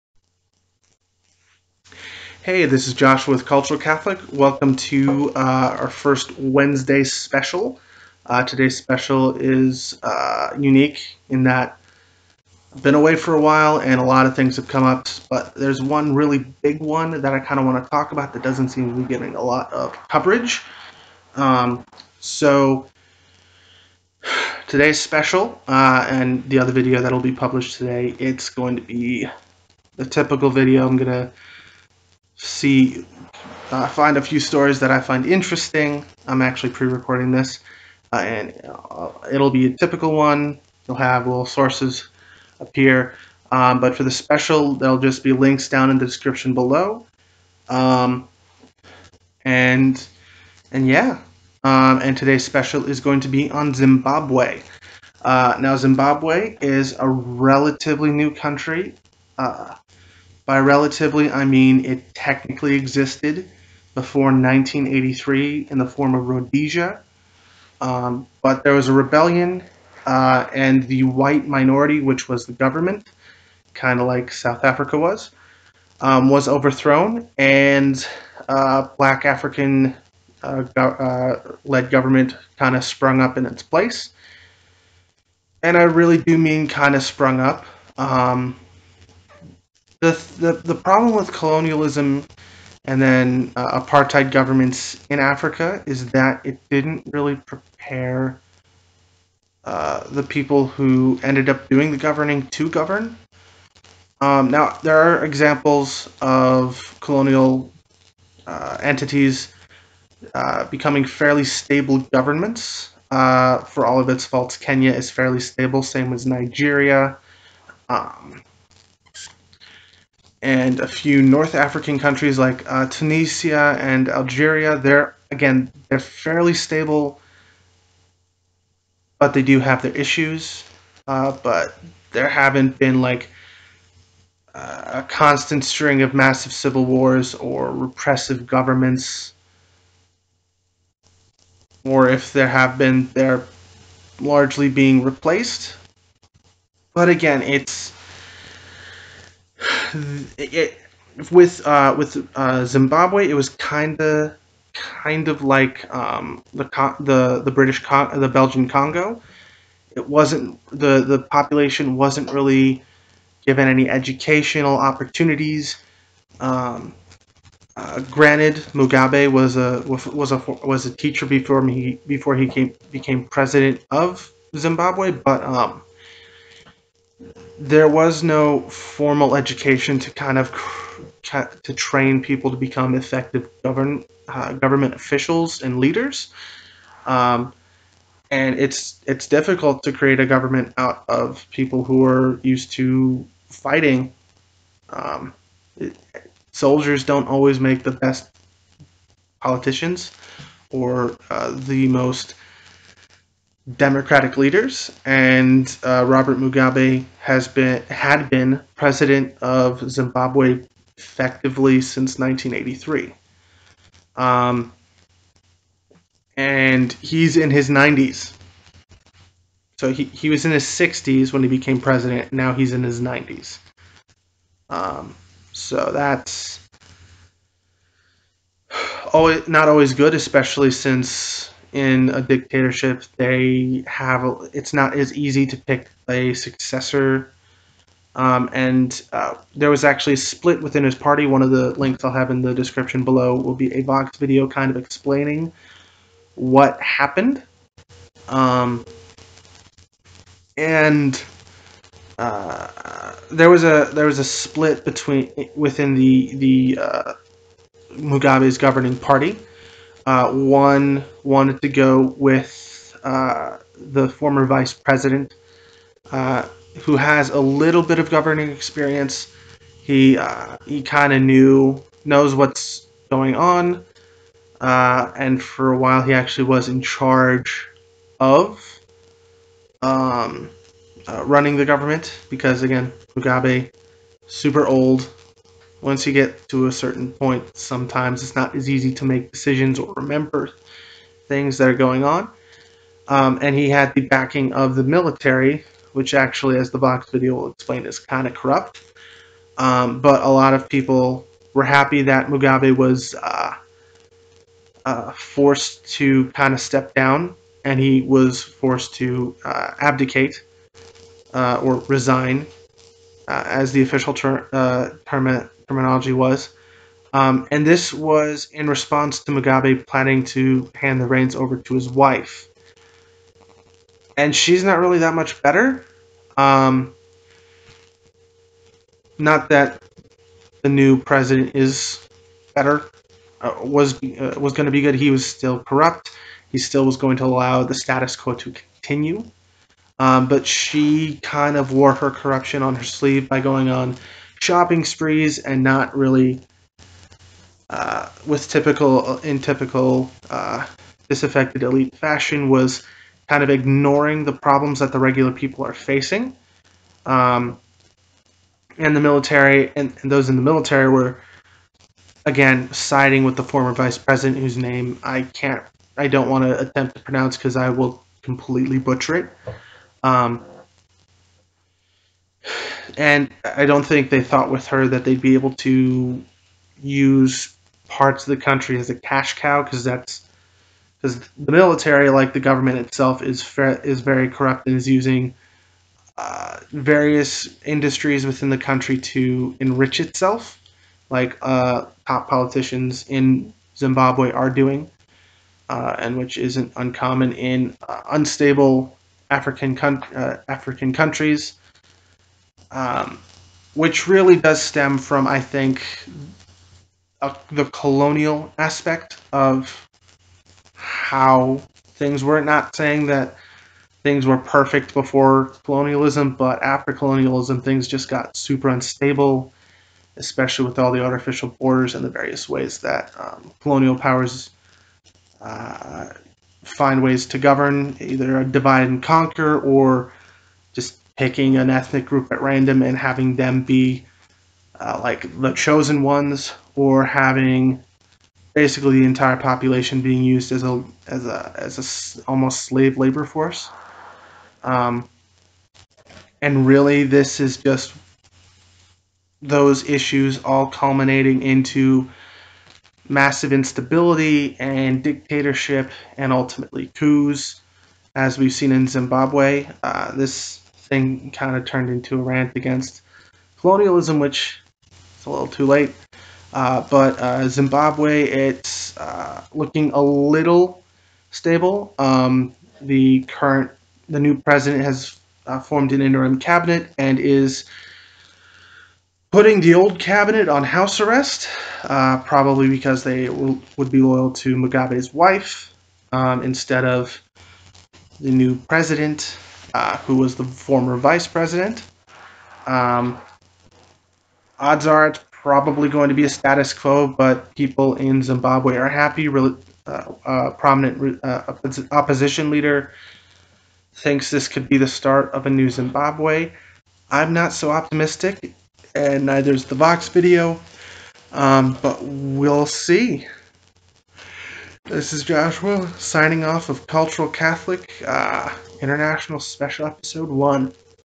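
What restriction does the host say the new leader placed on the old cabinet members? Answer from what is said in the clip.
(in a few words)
House arrest.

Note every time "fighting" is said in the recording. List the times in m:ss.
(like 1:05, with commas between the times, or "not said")
3:13.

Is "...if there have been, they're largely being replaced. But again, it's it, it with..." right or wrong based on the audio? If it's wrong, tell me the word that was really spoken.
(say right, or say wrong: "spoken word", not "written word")
right.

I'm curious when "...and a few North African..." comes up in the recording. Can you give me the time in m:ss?
2:00.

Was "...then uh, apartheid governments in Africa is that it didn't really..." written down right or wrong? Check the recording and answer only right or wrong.
right.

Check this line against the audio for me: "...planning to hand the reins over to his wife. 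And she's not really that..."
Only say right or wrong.
right.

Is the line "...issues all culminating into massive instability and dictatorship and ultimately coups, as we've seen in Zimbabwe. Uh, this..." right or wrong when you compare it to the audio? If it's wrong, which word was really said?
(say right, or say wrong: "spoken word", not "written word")
right.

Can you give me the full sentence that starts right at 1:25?
And I really do mean kind of sprung up.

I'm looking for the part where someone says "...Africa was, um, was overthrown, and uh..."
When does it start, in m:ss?
1:14.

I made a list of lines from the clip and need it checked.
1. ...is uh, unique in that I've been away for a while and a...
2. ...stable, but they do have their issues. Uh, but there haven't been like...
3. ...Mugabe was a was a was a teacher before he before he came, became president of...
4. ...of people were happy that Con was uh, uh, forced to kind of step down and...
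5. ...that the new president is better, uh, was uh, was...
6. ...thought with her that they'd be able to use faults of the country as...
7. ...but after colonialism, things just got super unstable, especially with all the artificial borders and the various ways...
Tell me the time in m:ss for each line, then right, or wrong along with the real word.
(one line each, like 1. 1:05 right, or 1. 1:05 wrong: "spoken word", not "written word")
1. 0:09 right
2. 2:06 right
3. 2:48 right
4. 5:00 wrong: "Mugabe", not "Con"
5. 5:29 right
6. 6:14 wrong: "parts", not "faults"
7. 6:56 right.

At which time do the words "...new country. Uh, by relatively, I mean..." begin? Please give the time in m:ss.
0:58.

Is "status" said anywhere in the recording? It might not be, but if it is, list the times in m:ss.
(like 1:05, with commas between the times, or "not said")
5:37, 8:16.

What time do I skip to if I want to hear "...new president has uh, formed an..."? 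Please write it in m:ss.
7:54.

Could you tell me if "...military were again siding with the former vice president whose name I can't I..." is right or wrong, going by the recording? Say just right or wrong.
right.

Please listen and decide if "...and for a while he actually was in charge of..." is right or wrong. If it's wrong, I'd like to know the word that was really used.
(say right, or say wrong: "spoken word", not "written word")
right.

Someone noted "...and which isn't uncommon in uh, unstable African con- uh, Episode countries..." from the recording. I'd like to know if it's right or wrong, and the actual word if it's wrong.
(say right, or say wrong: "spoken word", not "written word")
wrong: "African", not "Episode".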